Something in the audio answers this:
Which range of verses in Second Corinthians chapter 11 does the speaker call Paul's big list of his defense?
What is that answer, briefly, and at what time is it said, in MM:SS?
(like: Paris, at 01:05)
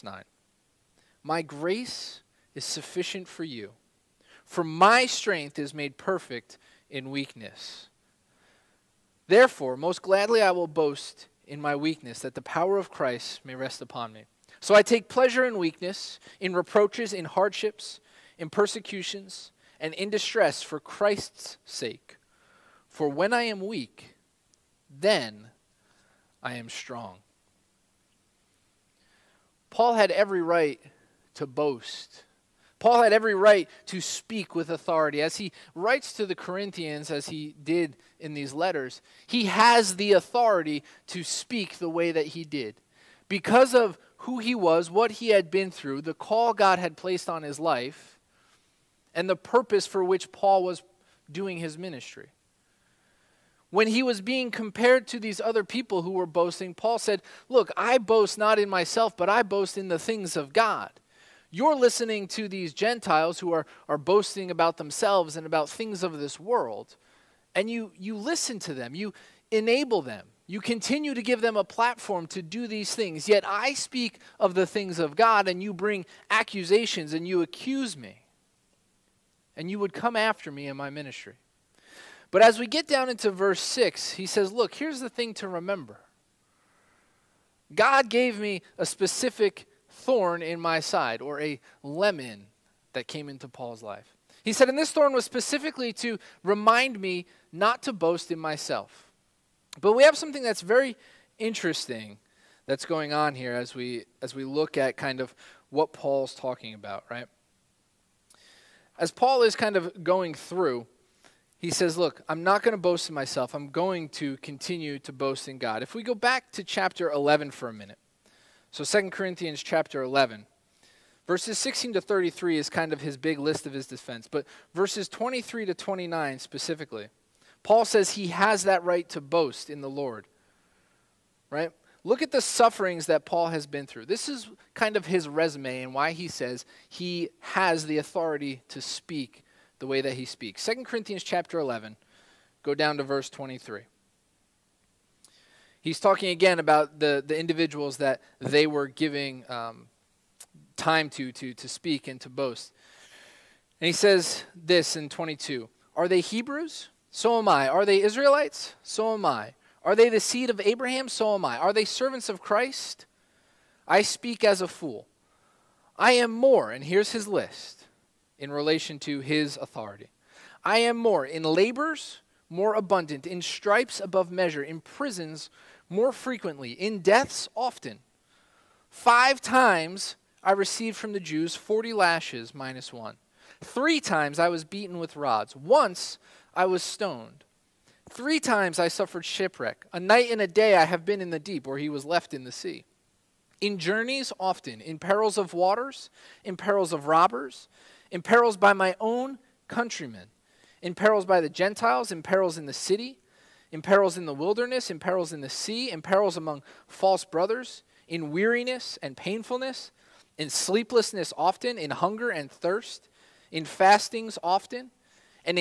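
16 to 33, at 02:01.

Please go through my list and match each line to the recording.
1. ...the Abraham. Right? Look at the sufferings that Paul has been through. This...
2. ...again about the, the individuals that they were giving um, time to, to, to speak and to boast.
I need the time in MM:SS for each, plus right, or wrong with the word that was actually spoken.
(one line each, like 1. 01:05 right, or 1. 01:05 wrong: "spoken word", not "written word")
1. 02:09 wrong: "Lord", not "Abraham"
2. 02:26 right.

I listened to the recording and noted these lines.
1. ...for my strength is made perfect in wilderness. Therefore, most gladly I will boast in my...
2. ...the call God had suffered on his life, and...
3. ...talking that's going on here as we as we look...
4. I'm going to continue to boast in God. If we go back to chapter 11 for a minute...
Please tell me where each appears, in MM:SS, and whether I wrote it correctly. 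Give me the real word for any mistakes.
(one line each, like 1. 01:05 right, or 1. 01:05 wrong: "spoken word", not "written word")
1. 00:04 wrong: "weakness", not "wilderness"
2. 00:46 wrong: "placed", not "suffered"
3. 01:41 wrong: "interesting", not "talking"
4. 01:53 right.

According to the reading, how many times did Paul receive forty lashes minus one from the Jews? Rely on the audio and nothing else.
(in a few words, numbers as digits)
5.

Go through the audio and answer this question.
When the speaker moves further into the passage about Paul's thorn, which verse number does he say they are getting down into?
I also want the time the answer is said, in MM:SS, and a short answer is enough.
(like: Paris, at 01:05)
6, at 01:23.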